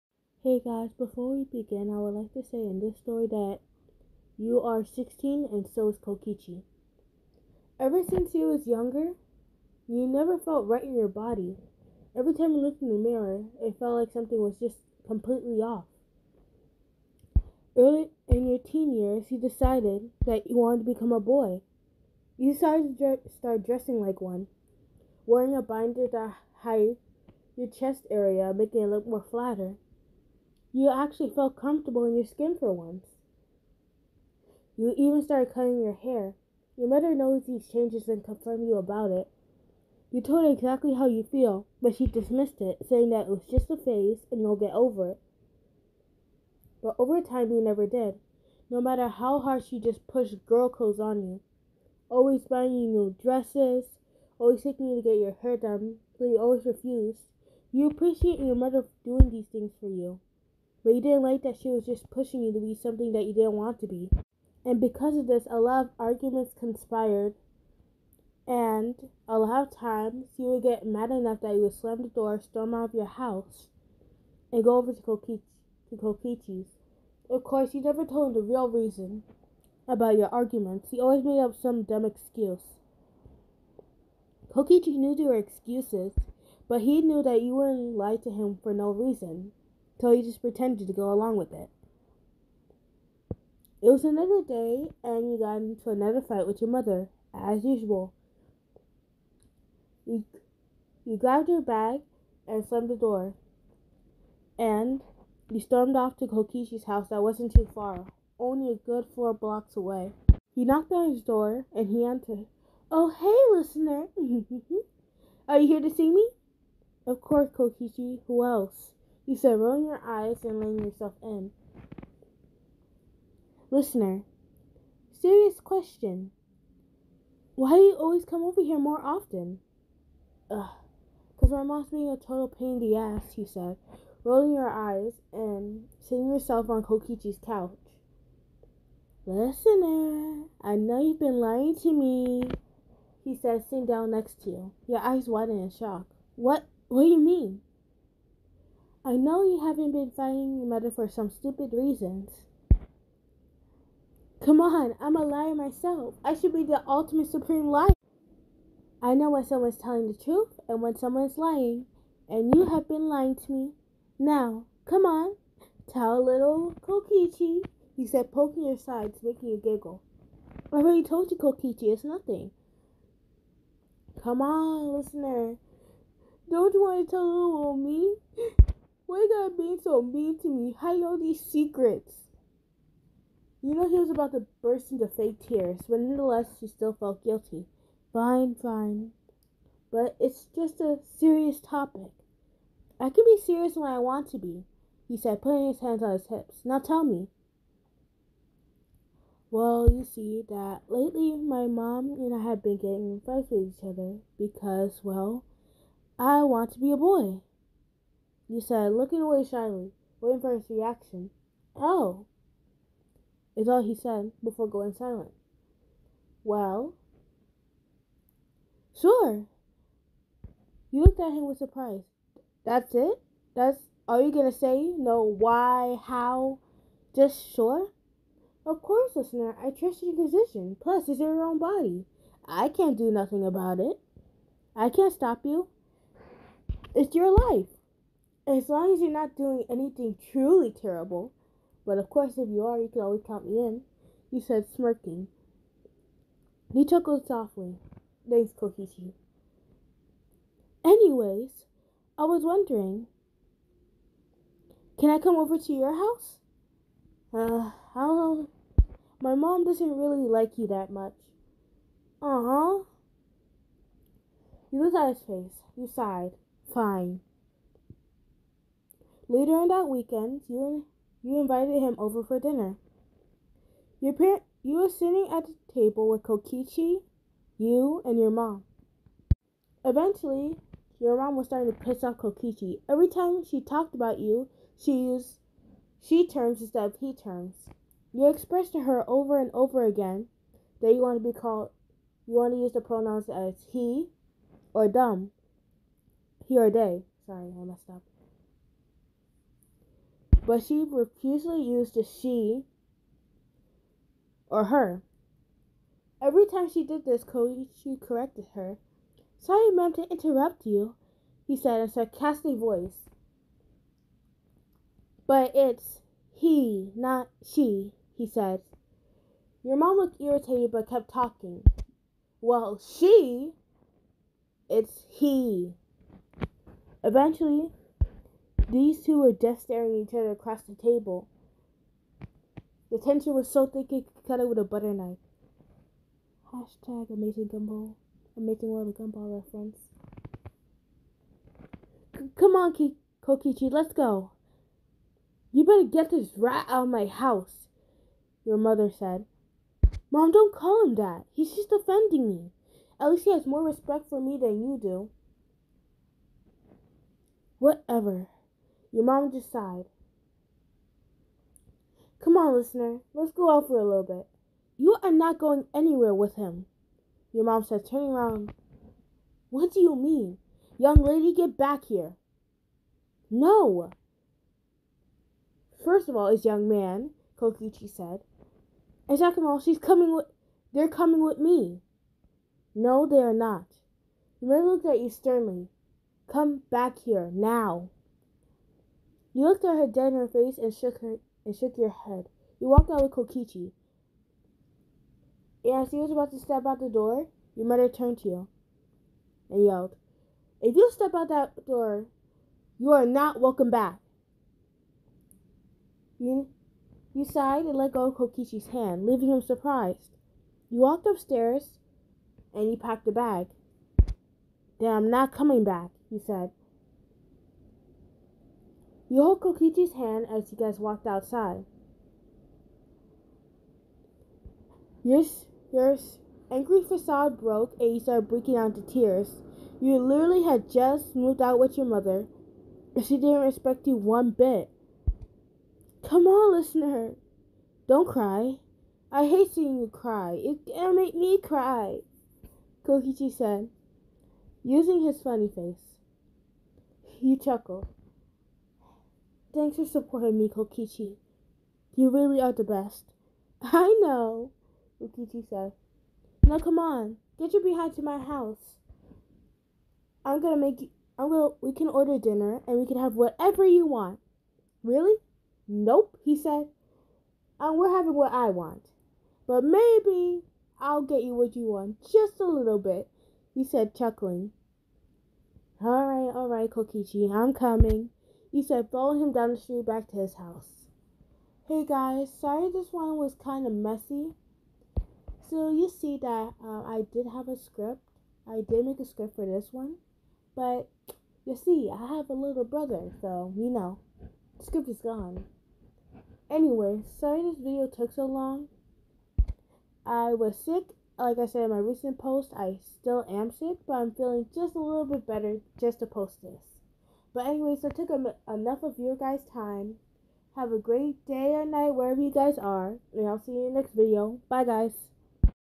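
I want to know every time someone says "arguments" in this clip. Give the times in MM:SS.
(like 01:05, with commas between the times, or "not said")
01:05, 01:20.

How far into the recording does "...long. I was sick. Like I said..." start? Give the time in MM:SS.
08:18.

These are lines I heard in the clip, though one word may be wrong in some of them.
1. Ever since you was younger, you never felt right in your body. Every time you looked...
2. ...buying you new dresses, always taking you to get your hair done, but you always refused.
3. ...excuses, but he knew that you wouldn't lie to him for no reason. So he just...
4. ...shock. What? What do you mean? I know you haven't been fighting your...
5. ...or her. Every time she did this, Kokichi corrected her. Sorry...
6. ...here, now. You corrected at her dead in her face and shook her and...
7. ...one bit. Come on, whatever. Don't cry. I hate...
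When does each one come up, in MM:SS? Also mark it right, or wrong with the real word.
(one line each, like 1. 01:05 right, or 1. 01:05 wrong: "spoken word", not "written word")
1. 00:07 right
2. 00:52 right
3. 01:25 right
4. 02:25 right
5. 05:04 right
6. 06:26 wrong: "looked", not "corrected"
7. 07:13 wrong: "listener", not "whatever".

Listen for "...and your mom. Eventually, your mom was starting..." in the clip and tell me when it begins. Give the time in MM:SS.
04:38.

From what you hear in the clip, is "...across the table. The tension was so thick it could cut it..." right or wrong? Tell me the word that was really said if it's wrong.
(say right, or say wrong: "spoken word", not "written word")
right.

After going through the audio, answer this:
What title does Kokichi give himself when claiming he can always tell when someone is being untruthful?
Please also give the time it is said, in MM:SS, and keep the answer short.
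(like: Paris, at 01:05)
Ultimate supreme liar, at 02:36.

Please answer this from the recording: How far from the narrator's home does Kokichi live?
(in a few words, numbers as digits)
4 blocks.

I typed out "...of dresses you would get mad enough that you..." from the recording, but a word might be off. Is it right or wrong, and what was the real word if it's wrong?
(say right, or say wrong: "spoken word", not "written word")
wrong: "times", not "dresses".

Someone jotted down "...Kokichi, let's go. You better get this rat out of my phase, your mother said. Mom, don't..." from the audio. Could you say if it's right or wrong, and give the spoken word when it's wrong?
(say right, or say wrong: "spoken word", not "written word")
wrong: "house", not "phase".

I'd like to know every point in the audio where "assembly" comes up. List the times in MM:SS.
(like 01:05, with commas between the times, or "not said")
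not said.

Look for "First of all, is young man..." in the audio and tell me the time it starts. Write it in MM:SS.
06:15.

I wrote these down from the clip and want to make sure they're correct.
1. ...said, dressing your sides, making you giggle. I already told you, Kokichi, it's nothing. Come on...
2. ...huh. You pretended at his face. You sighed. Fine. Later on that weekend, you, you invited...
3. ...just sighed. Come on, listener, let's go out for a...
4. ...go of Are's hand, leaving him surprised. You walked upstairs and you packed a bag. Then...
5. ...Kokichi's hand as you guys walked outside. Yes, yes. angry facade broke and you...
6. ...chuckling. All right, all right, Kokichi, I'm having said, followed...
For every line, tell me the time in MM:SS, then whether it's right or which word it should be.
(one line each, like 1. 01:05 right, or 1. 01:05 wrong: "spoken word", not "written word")
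1. 02:48 wrong: "poking", not "dressing"
2. 04:22 wrong: "looked", not "pretended"
3. 05:59 right
4. 06:47 wrong: "Kokichi", not "Are"
5. 06:59 right
6. 07:53 wrong: "coming", not "having".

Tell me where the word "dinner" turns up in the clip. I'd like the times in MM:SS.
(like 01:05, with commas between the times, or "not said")
04:32, 07:42.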